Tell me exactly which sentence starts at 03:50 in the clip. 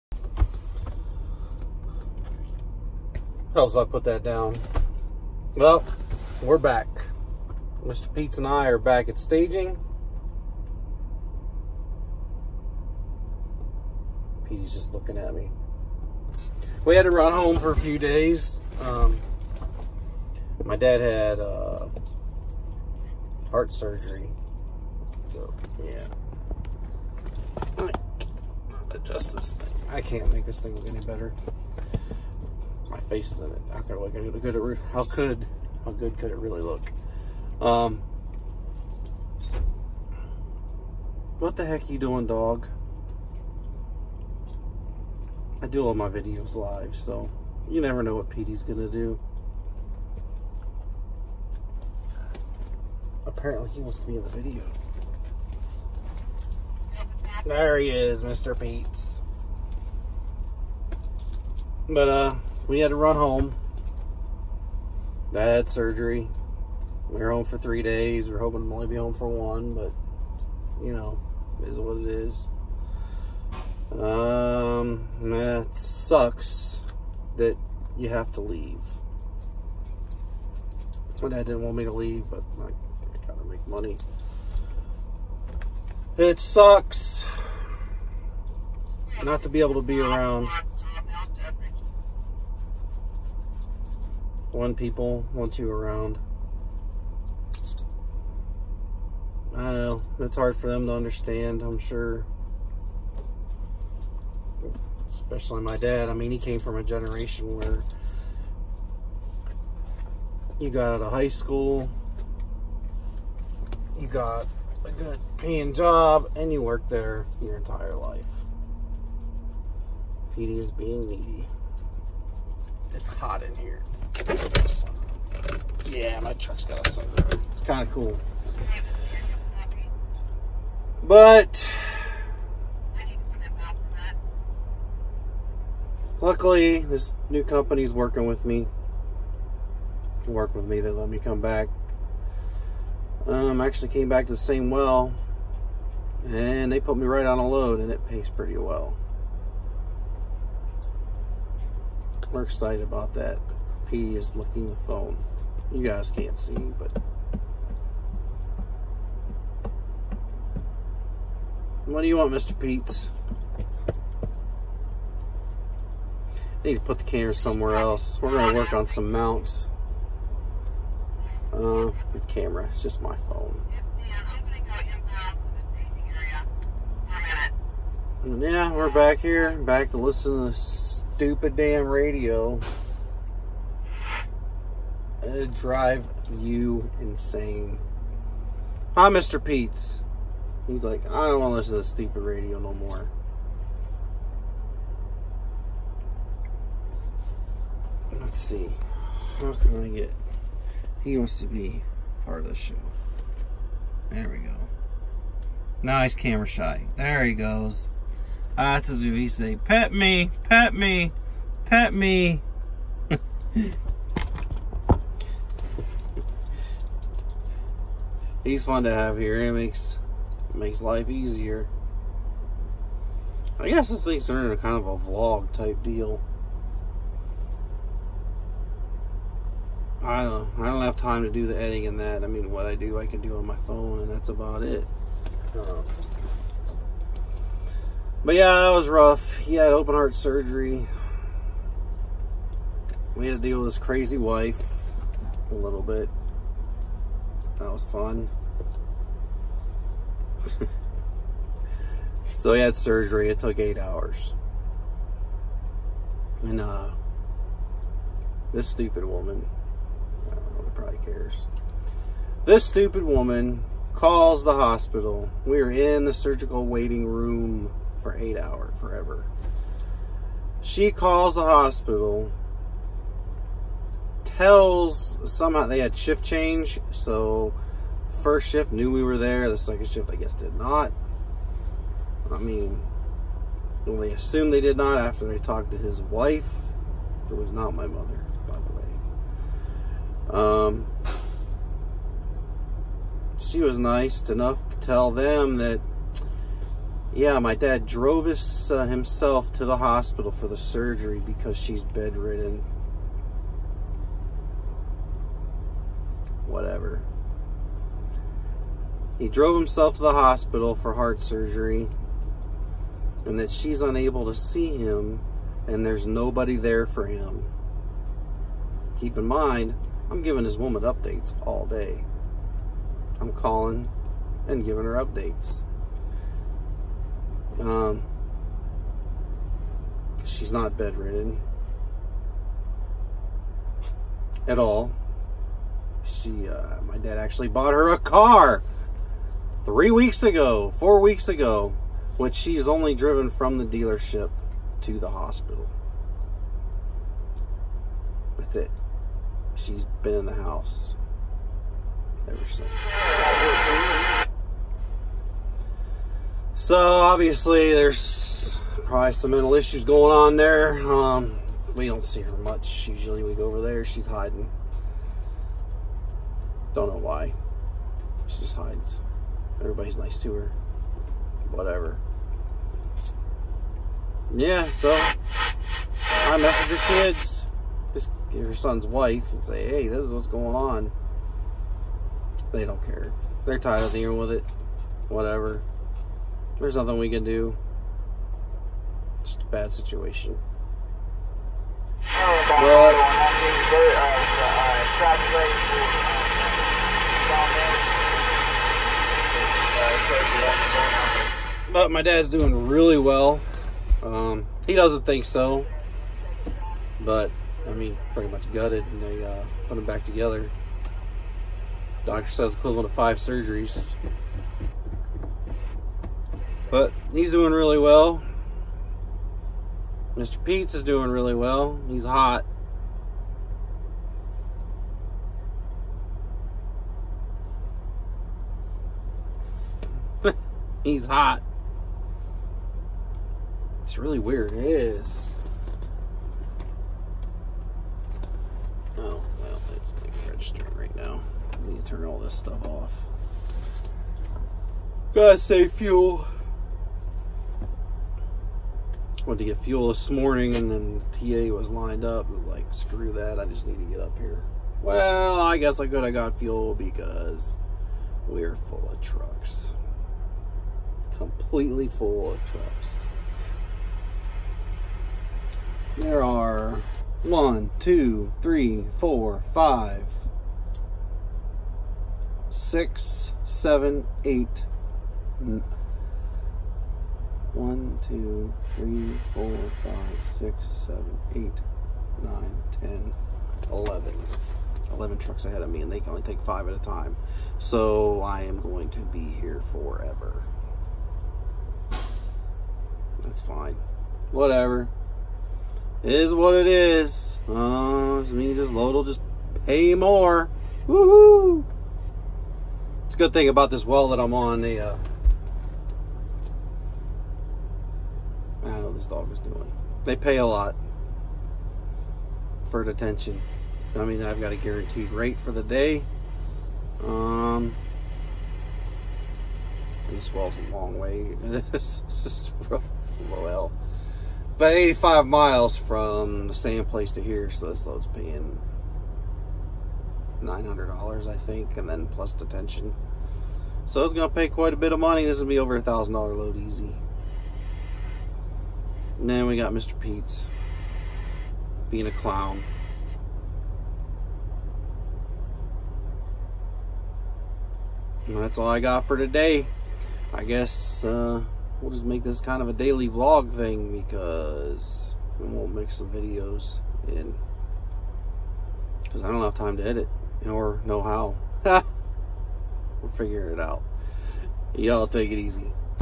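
I don't I don't have time to do the editing and that.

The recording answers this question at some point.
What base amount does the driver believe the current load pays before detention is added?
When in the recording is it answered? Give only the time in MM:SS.
08:50.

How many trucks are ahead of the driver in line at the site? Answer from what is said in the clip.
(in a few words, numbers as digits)
11.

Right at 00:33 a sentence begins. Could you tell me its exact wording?
How could, look, good how could how good could it really look?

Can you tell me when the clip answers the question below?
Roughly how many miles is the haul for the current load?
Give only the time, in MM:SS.
08:44.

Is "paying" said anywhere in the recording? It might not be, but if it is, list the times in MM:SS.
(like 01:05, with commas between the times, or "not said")
01:55, 08:48.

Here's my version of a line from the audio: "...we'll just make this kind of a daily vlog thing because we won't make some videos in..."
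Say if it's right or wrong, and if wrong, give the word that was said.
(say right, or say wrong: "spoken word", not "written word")
right.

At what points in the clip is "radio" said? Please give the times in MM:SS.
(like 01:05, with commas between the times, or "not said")
03:01, 03:12.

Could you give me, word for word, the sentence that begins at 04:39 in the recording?
The second shift, I guess, did not.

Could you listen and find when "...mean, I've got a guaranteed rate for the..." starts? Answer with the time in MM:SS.
08:34.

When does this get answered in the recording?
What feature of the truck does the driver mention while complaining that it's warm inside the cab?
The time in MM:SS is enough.
02:06.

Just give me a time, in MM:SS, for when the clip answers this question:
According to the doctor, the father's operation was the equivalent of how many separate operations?
06:52.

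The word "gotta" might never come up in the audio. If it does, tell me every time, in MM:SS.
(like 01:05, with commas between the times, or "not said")
01:23, 07:25.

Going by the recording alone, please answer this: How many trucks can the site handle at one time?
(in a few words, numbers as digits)
5.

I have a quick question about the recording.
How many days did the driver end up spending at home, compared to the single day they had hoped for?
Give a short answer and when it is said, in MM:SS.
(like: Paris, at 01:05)
3, at 01:07.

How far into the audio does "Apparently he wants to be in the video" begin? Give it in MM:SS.
00:53.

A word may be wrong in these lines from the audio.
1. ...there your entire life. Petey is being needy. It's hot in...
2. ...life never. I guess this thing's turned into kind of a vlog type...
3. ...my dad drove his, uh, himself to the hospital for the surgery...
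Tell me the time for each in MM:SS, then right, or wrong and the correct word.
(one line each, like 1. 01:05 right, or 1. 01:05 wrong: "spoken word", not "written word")
1. 01:56 right
2. 03:40 wrong: "easier", not "never"
3. 04:57 right.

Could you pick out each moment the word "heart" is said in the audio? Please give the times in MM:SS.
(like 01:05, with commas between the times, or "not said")
00:23, 03:59, 05:10.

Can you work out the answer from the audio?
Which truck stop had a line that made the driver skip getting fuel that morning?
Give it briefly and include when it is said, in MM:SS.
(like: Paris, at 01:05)
TA, at 07:31.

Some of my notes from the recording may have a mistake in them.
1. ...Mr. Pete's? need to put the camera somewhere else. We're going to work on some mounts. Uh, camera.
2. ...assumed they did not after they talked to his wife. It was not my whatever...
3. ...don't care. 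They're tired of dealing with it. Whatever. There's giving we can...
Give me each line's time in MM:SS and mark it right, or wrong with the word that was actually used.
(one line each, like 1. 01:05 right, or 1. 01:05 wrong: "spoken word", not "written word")
1. 02:42 right
2. 04:44 wrong: "mother", not "whatever"
3. 06:22 wrong: "nothing", not "giving".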